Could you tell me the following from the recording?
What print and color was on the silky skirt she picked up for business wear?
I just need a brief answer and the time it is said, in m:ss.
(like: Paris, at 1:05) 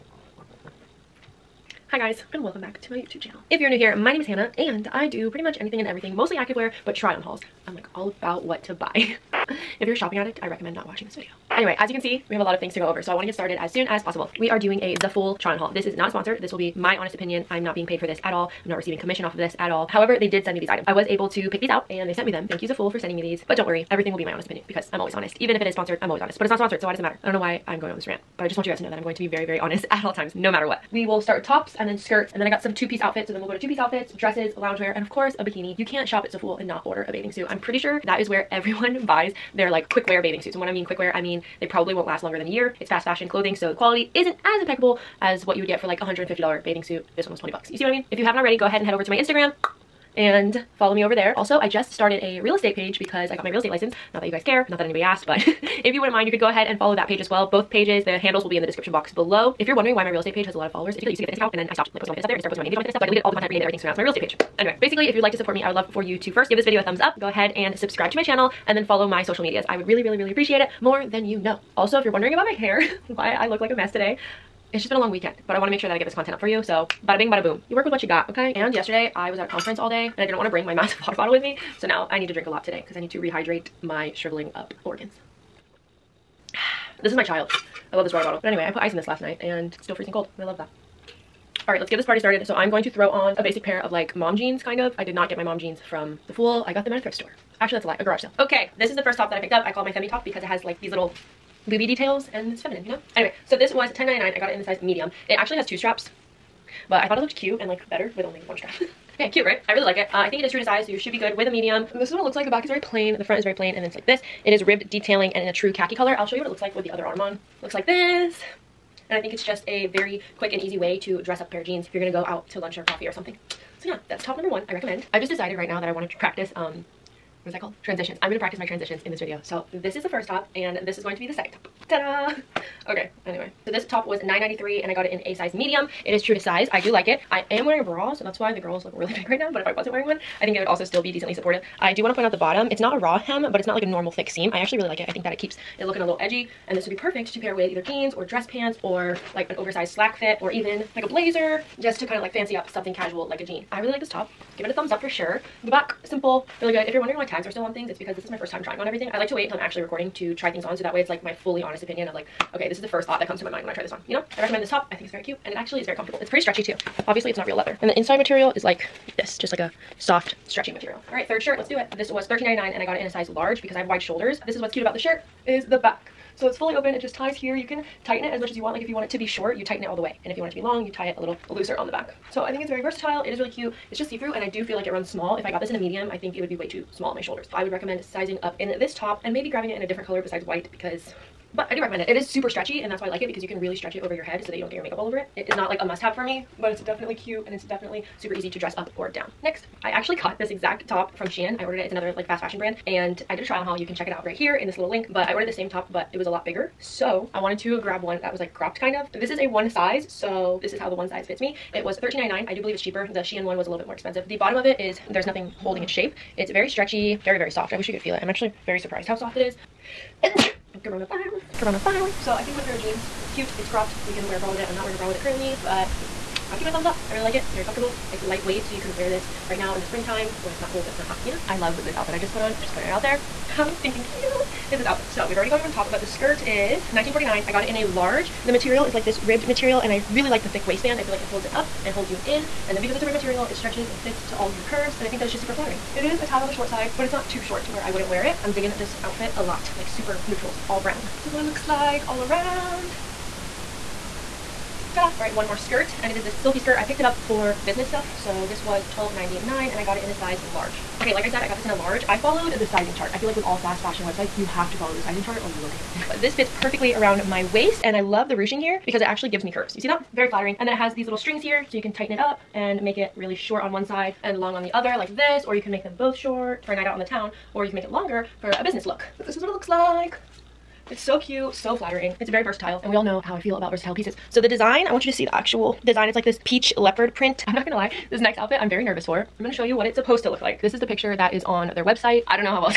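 Peach leopard print, at 4:46.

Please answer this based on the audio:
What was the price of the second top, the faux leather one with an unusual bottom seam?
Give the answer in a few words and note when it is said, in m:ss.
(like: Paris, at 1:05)
$9.93, at 2:14.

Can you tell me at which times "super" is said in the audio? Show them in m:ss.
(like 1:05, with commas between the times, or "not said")
3:12, 3:18, 4:05, 4:09.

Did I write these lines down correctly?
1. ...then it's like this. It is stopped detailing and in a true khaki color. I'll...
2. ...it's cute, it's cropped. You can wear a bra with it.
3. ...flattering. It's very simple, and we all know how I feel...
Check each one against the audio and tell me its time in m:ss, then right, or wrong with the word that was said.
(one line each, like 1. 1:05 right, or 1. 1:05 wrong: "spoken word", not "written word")
1. 1:53 wrong: "ribbed", not "stopped"
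2. 3:43 right
3. 4:41 wrong: "versatile", not "simple".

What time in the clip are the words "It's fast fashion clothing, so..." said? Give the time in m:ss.
0:42.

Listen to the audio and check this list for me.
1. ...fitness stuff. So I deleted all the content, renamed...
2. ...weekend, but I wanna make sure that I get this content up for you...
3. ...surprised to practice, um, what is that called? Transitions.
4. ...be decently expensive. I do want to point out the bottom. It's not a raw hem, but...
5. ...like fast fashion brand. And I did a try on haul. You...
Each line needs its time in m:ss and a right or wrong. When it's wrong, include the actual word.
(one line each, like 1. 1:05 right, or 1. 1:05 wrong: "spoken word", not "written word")
1. 1:02 right
2. 1:15 right
3. 2:05 wrong: "wanted", not "surprised"
4. 2:21 wrong: "supportive", not "expensive"
5. 3:22 right.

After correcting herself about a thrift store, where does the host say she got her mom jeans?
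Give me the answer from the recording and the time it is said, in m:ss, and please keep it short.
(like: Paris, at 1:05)
A garage sale, at 1:37.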